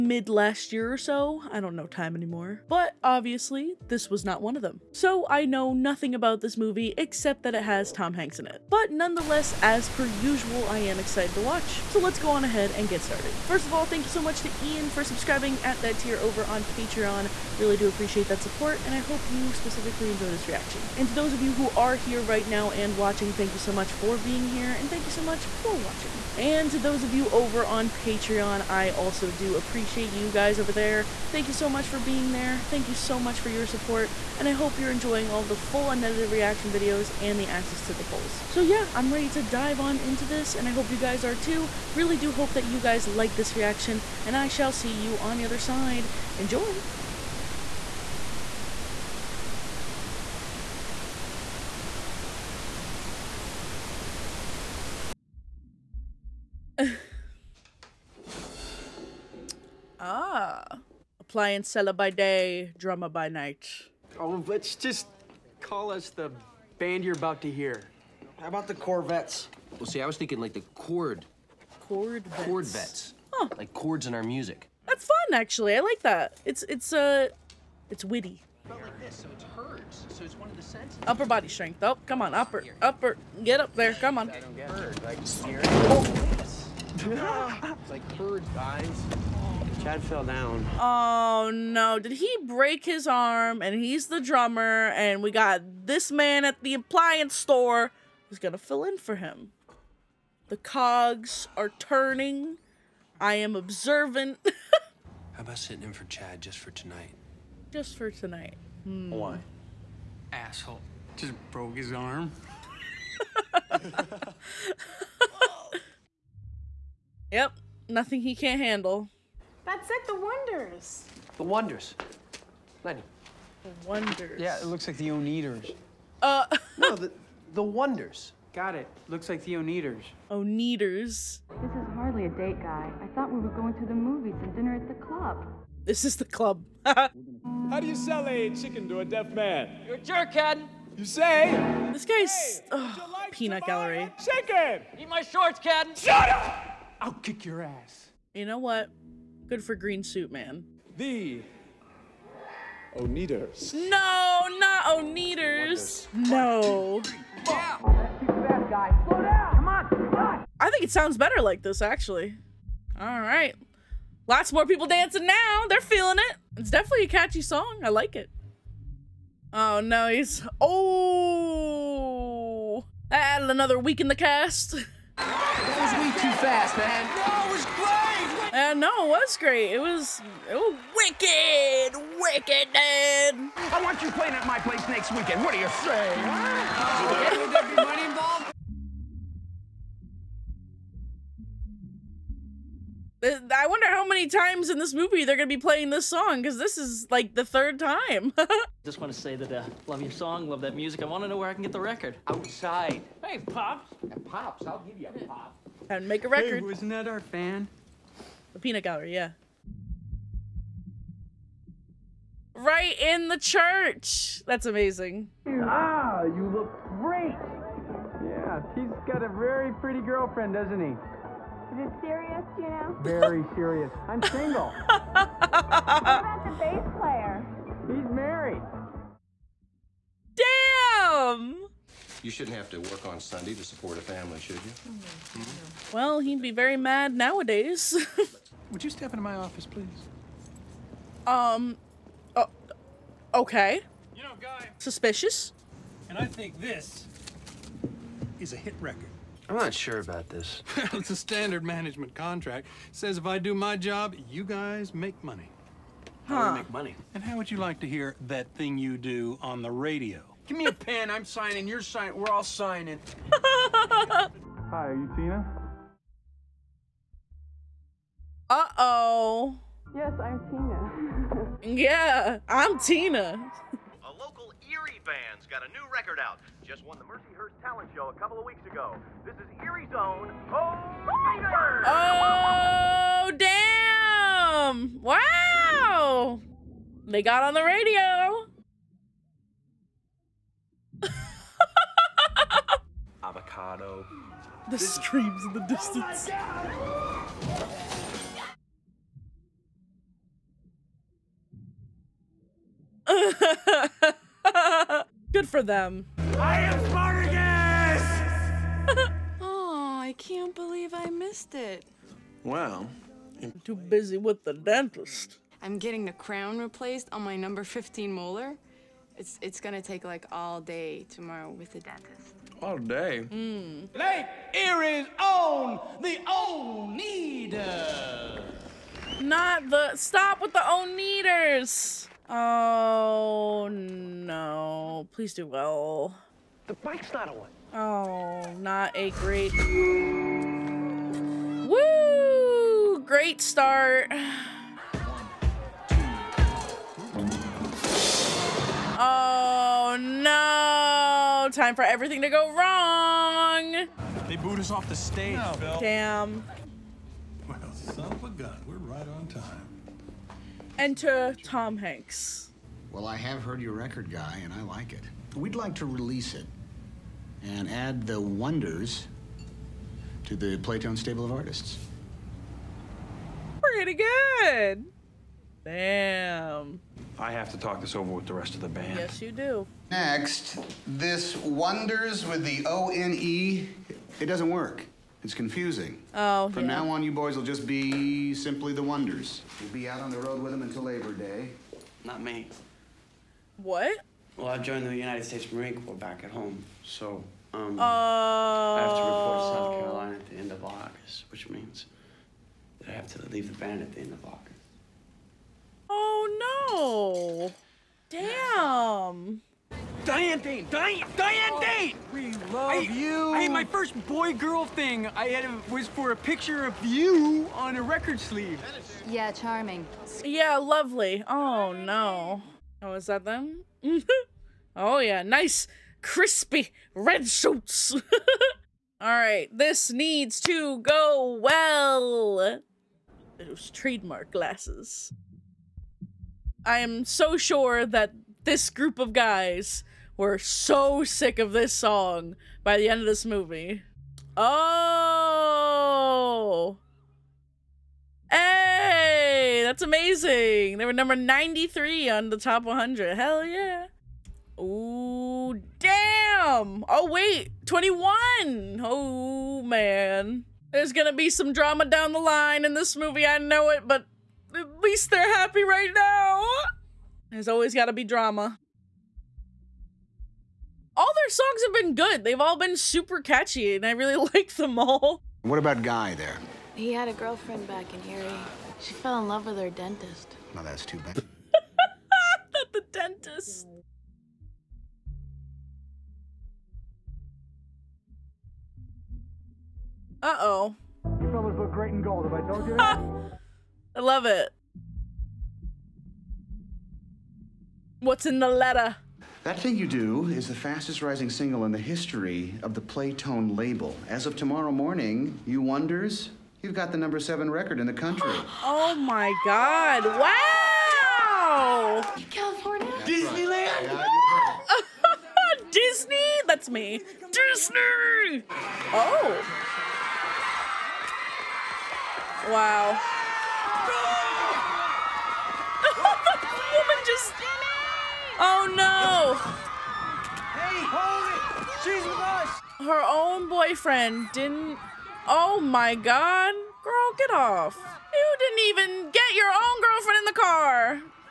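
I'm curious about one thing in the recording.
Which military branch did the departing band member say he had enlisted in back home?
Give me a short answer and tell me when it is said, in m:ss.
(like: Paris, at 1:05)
United States Marine Corps, at 6:34.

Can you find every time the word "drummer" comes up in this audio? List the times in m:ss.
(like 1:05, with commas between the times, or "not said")
1:02, 1:34.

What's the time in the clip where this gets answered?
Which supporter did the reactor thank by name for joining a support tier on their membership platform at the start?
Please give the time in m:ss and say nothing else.
0:14.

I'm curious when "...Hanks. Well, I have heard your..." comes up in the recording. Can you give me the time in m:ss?
6:01.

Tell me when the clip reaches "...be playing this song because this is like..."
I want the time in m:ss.
3:15.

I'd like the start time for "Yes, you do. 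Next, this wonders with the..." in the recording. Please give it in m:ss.
6:18.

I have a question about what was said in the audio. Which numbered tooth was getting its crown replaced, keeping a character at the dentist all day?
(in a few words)
15.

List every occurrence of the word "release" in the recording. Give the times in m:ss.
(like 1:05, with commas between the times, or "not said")
6:05.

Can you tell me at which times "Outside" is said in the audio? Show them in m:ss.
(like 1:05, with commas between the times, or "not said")
3:22.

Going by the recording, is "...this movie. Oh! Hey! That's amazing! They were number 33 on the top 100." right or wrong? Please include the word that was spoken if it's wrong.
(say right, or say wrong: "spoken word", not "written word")
wrong: "93", not "33".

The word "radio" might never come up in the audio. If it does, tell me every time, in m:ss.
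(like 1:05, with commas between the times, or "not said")
4:19, 4:47.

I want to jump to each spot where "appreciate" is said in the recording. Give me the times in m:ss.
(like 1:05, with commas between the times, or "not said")
0:17, 0:29.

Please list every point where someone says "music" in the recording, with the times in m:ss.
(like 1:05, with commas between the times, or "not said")
1:14, 3:20.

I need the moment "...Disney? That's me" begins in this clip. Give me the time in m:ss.
8:35.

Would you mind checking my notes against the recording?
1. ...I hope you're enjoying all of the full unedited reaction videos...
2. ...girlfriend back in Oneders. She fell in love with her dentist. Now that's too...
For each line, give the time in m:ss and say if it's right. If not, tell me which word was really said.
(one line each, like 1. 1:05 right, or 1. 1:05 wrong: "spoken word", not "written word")
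1. 0:34 right
2. 7:57 wrong: "Erie", not "Oneders".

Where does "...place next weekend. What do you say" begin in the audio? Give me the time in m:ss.
3:04.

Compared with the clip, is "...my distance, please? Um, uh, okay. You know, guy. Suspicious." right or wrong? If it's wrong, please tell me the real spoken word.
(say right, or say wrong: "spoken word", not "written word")
wrong: "office", not "distance".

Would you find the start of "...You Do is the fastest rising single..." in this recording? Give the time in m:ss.
8:19.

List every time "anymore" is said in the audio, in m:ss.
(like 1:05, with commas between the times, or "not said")
0:02.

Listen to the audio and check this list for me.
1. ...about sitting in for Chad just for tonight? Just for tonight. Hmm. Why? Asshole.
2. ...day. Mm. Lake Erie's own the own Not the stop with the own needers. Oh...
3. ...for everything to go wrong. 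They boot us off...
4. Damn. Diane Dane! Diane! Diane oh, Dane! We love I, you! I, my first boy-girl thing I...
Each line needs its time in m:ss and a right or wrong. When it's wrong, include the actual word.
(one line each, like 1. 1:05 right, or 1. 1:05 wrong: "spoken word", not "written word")
1. 1:45 right
2. 5:22 right
3. 5:51 right
4. 6:48 right.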